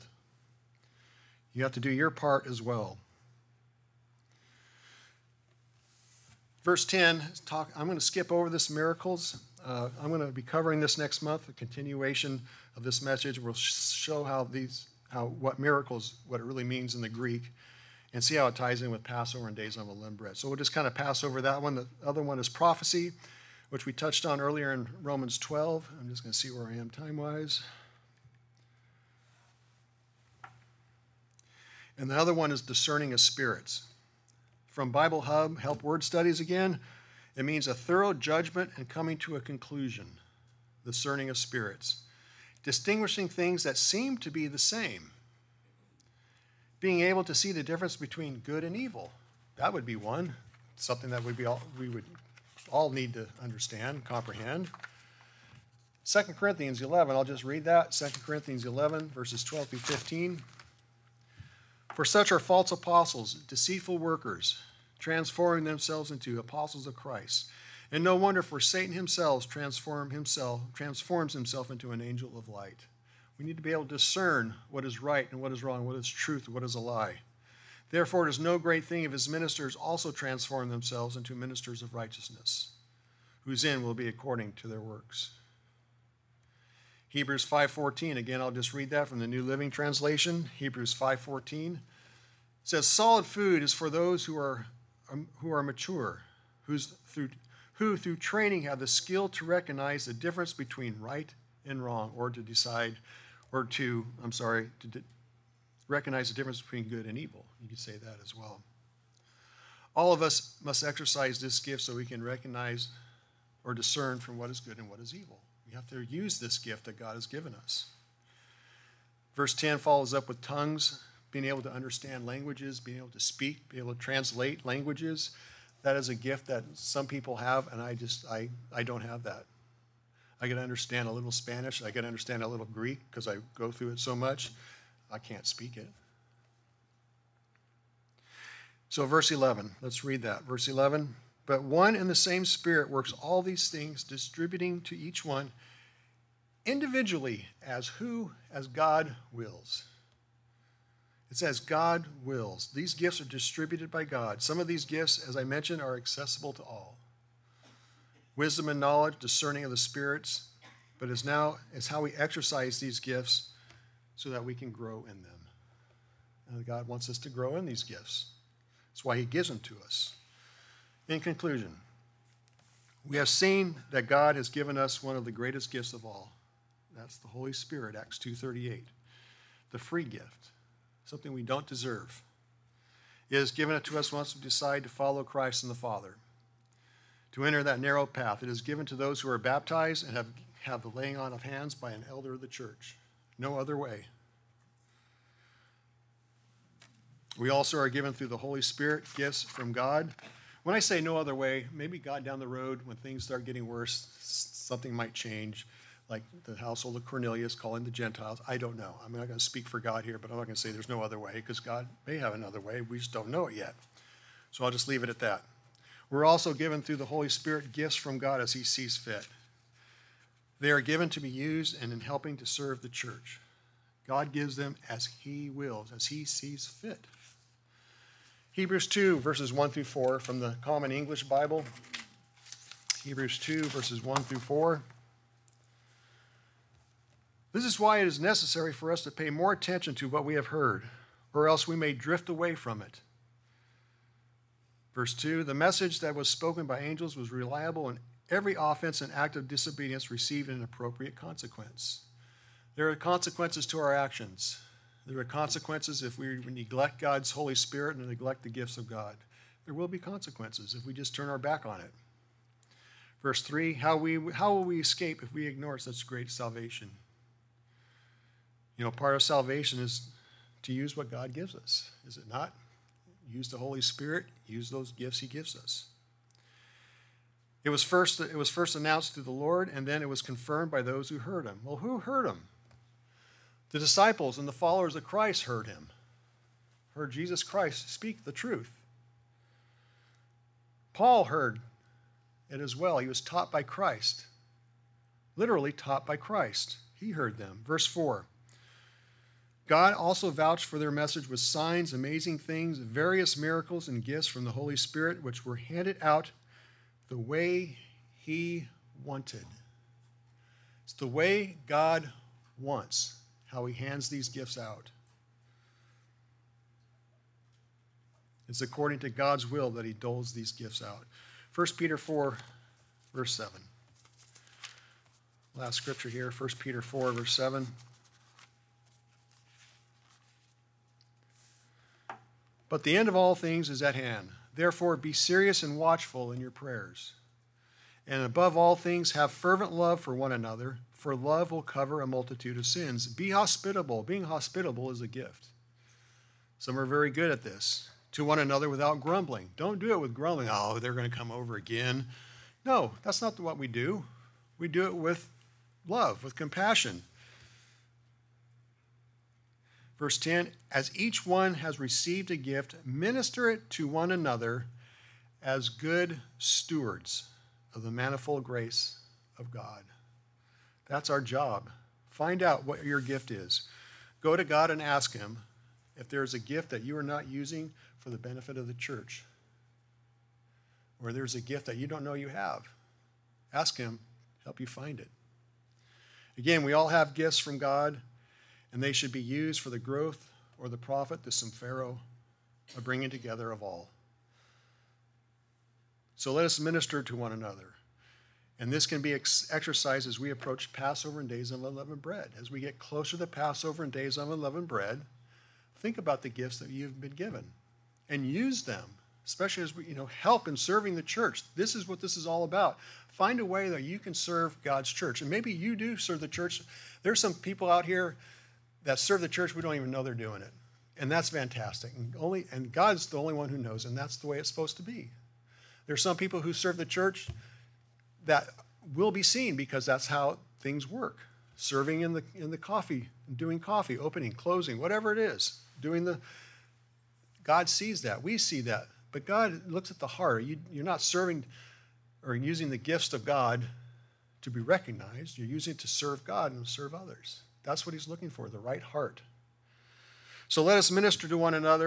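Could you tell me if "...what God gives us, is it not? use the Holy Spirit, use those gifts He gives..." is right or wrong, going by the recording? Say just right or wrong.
right.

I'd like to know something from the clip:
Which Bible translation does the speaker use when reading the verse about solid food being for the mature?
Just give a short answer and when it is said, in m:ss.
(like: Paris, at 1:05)
New Living Translation, at 1:29.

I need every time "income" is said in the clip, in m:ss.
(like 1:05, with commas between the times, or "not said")
not said.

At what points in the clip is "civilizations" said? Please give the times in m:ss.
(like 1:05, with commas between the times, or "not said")
not said.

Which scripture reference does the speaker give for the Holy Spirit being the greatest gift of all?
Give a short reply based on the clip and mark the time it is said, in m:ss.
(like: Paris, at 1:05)
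Acts 2:38, at 2:57.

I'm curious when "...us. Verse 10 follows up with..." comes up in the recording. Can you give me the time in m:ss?
1:57.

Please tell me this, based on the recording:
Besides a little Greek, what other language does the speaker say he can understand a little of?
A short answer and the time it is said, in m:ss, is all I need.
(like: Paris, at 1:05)
Spanish, at 2:11.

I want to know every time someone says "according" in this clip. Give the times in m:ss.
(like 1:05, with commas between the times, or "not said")
1:24, 5:18.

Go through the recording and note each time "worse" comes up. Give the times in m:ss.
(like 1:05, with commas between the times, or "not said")
3:23.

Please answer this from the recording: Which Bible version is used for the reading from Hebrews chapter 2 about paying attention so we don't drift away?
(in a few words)
Common English Bible.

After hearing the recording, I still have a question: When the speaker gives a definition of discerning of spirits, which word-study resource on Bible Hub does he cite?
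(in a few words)
HELPS Word Studies.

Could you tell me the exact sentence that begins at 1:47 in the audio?
You could say that as well.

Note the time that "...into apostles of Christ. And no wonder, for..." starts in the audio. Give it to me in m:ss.
1:06.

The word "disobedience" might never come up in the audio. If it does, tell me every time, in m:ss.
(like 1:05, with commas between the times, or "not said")
4:09.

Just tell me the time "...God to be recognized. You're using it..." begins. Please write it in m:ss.
7:23.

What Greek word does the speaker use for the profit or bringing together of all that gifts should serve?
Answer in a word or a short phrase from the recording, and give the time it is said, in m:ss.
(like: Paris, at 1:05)
symphero, at 6:31.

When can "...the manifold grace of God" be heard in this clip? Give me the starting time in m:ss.
6:07.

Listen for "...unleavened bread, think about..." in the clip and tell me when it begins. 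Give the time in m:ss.
6:44.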